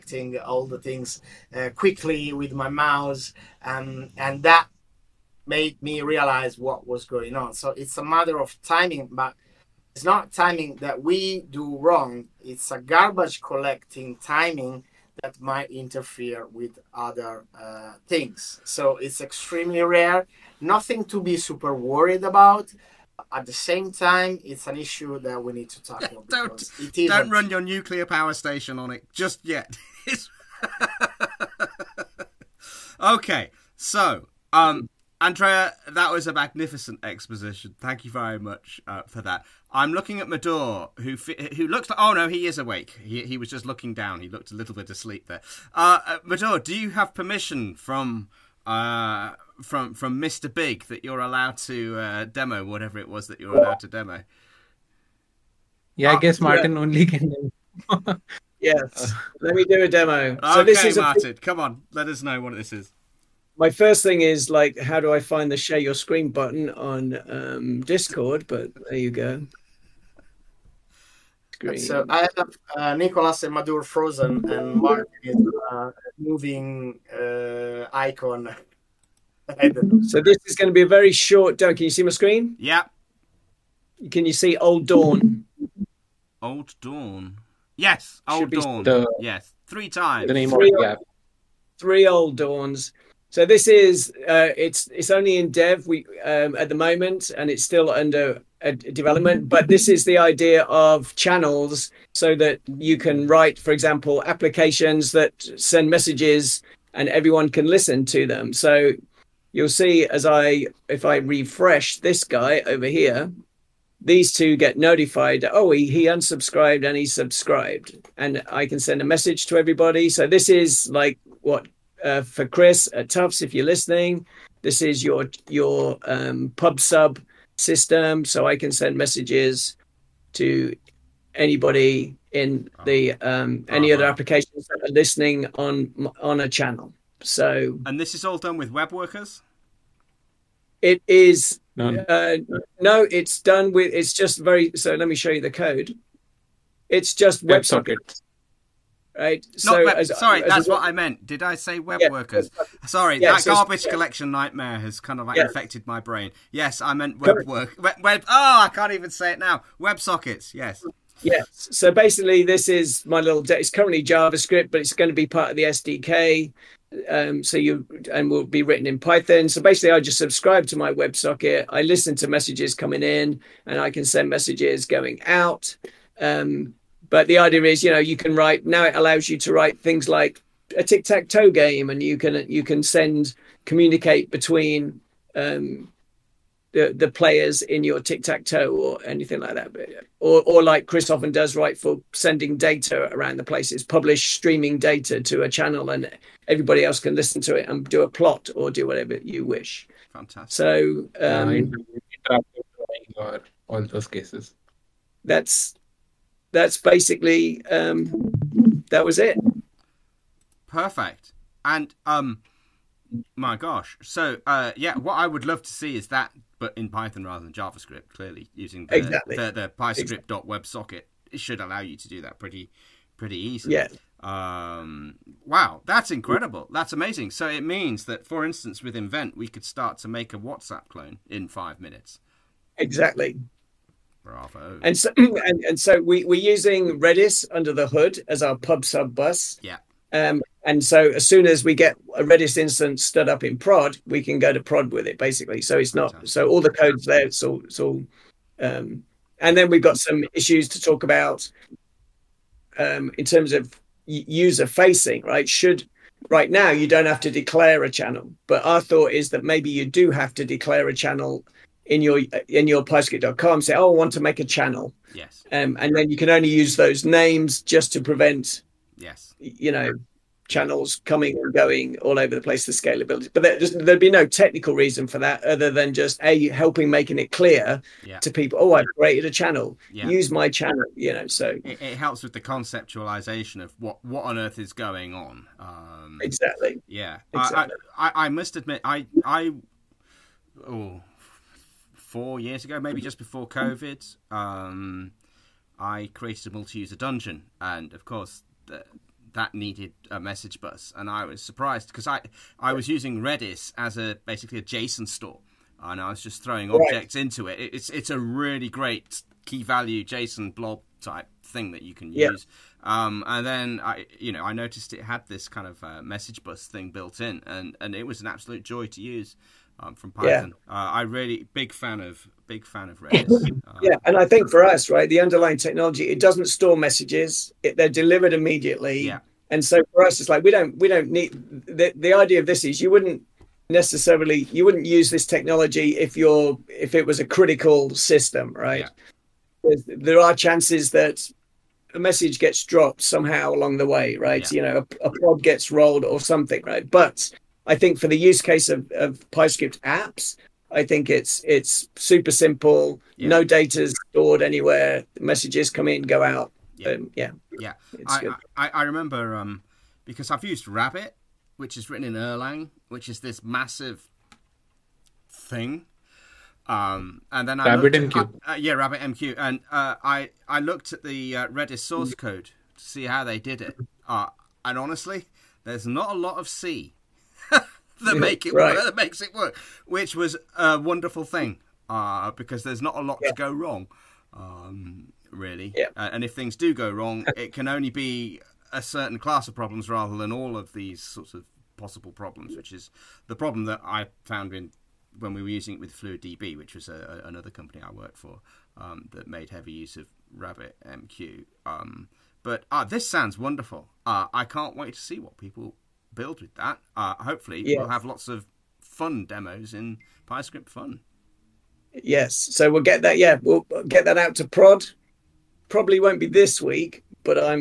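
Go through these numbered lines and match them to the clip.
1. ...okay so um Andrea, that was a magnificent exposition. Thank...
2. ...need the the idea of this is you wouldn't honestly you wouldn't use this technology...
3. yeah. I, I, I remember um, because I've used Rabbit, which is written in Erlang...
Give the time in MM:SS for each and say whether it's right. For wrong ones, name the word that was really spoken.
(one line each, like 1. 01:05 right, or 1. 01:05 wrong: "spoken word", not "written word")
1. 00:32 right
2. 05:31 wrong: "necessarily", not "honestly"
3. 05:57 right.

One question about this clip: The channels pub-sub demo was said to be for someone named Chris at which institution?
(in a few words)
Tufts.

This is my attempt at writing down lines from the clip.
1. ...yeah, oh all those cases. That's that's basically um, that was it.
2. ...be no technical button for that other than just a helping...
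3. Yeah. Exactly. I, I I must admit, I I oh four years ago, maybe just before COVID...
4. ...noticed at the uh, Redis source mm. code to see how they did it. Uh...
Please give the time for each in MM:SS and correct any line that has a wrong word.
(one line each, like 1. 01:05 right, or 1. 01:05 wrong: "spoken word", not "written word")
1. 03:22 right
2. 04:33 wrong: "reason", not "button"
3. 04:46 right
4. 06:10 wrong: "looked", not "noticed".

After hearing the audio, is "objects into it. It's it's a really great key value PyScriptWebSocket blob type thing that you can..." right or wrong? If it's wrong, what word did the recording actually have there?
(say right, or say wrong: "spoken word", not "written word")
wrong: "JSON", not "PyScriptWebSocket".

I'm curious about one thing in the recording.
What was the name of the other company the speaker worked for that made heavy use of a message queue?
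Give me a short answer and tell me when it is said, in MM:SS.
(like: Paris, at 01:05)
Fluid DB, at 06:35.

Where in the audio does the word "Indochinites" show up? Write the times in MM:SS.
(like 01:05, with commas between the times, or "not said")
not said.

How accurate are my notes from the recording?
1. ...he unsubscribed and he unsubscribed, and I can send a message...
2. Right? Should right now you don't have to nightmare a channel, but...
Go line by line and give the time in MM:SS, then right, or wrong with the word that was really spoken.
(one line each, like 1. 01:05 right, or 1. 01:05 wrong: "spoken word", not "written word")
1. 01:55 wrong: "subscribed", not "unsubscribed"
2. 04:15 wrong: "declare", not "nightmare".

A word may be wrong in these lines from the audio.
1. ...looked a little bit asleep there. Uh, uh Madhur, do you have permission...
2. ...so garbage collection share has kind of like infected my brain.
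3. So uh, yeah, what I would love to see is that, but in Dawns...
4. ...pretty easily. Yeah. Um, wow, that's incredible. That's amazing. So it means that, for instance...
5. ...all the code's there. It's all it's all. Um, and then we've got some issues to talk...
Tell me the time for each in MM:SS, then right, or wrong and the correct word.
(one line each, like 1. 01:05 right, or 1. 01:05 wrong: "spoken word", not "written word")
1. 00:44 right
2. 02:33 wrong: "nightmare", not "share"
3. 03:34 wrong: "Python", not "Dawns"
4. 03:43 right
5. 04:06 right.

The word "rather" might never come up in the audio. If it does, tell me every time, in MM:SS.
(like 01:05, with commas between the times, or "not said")
03:37, 06:29.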